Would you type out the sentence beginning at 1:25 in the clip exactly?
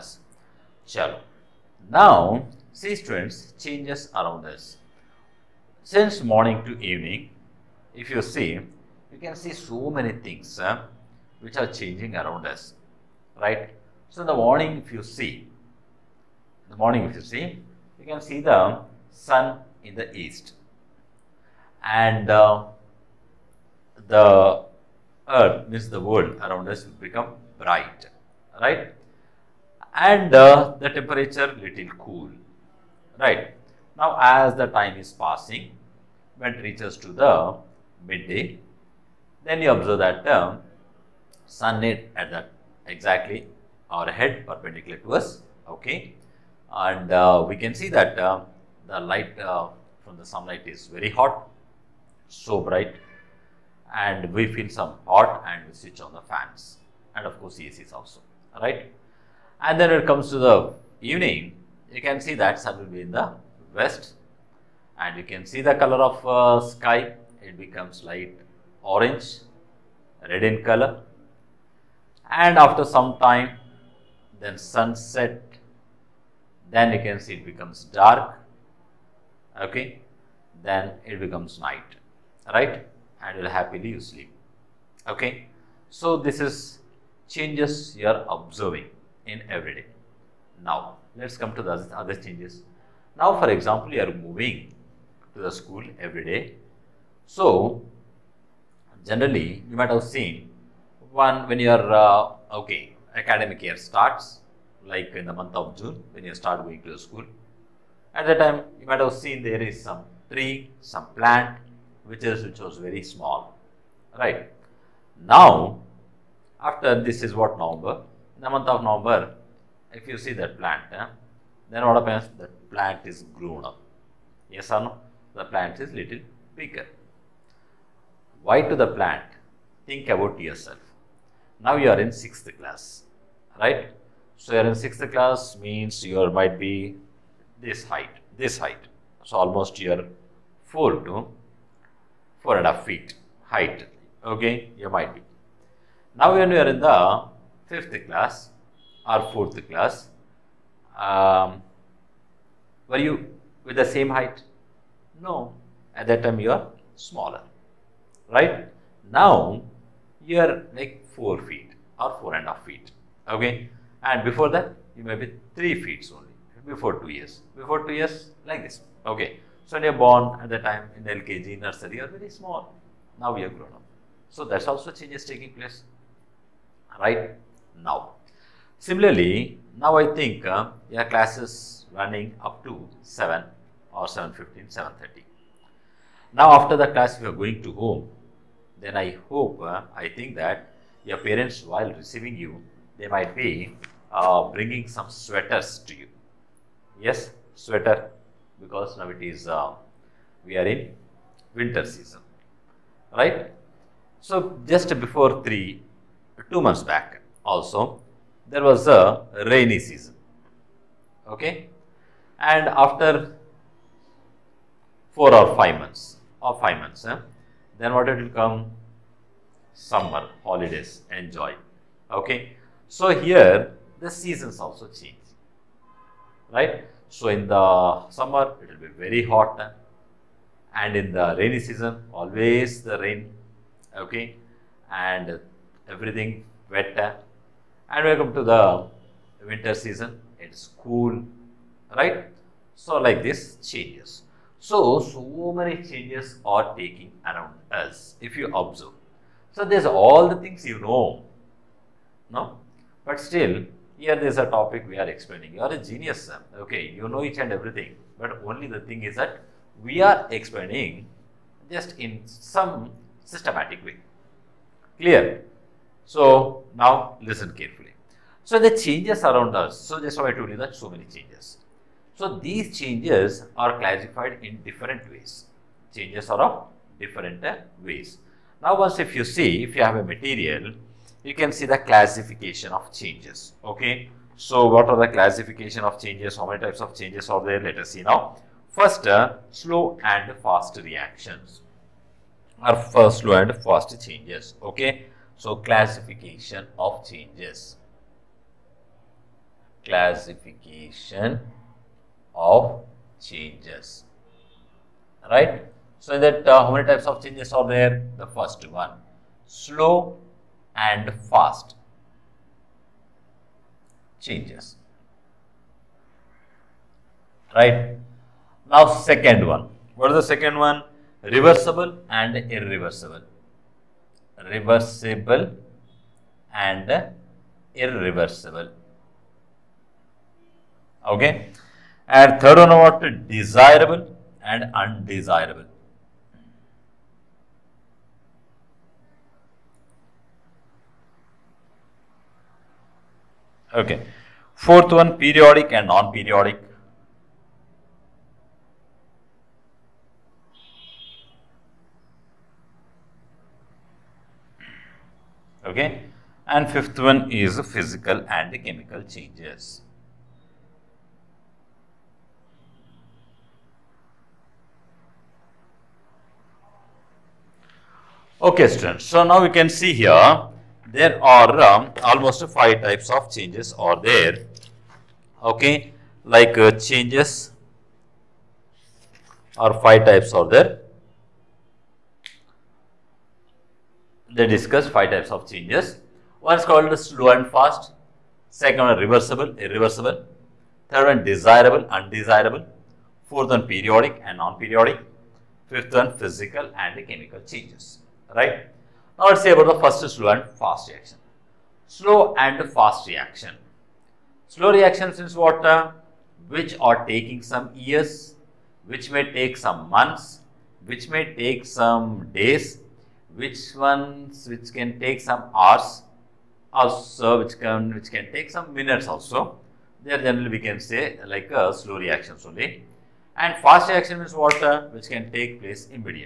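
So, this is changes you are observing in every day.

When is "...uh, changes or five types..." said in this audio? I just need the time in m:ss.
6:16.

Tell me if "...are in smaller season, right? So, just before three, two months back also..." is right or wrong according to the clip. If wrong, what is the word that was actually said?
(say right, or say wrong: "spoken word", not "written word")
wrong: "winter", not "smaller".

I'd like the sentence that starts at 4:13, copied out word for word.
But still, here there's a topic we are explaining.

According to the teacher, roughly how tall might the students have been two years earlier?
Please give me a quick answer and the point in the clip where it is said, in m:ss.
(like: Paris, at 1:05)
3 feet, at 2:45.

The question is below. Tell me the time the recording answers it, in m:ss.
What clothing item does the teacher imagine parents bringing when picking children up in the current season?
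3:15.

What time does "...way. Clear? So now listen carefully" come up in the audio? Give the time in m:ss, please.
4:23.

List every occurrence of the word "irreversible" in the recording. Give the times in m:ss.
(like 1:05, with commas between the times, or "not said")
5:22, 5:27, 6:29.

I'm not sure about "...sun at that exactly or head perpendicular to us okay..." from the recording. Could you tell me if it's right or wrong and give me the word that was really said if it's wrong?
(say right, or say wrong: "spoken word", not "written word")
right.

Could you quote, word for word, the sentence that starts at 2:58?
Similarly, now I think uh, your classes running up to 7 or 7.15, 7.30.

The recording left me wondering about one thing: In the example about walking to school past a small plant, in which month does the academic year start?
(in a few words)
June.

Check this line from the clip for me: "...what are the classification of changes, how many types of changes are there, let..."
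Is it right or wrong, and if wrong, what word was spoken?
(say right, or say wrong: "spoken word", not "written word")
right.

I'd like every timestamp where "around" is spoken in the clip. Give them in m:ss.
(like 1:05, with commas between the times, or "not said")
0:04, 0:12, 0:26, 4:07, 4:29.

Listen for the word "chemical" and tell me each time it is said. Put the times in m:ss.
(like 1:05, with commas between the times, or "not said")
5:58, 6:37.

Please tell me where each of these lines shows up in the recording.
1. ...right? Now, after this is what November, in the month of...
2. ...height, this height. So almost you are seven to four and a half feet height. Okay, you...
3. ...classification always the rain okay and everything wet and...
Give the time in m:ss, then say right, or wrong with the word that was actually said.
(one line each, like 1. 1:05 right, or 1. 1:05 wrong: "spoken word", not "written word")
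1. 1:54 right
2. 2:17 wrong: "four", not "seven"
3. 3:51 wrong: "season", not "classification".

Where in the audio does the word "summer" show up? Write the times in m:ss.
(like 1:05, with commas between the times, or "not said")
3:39, 3:48.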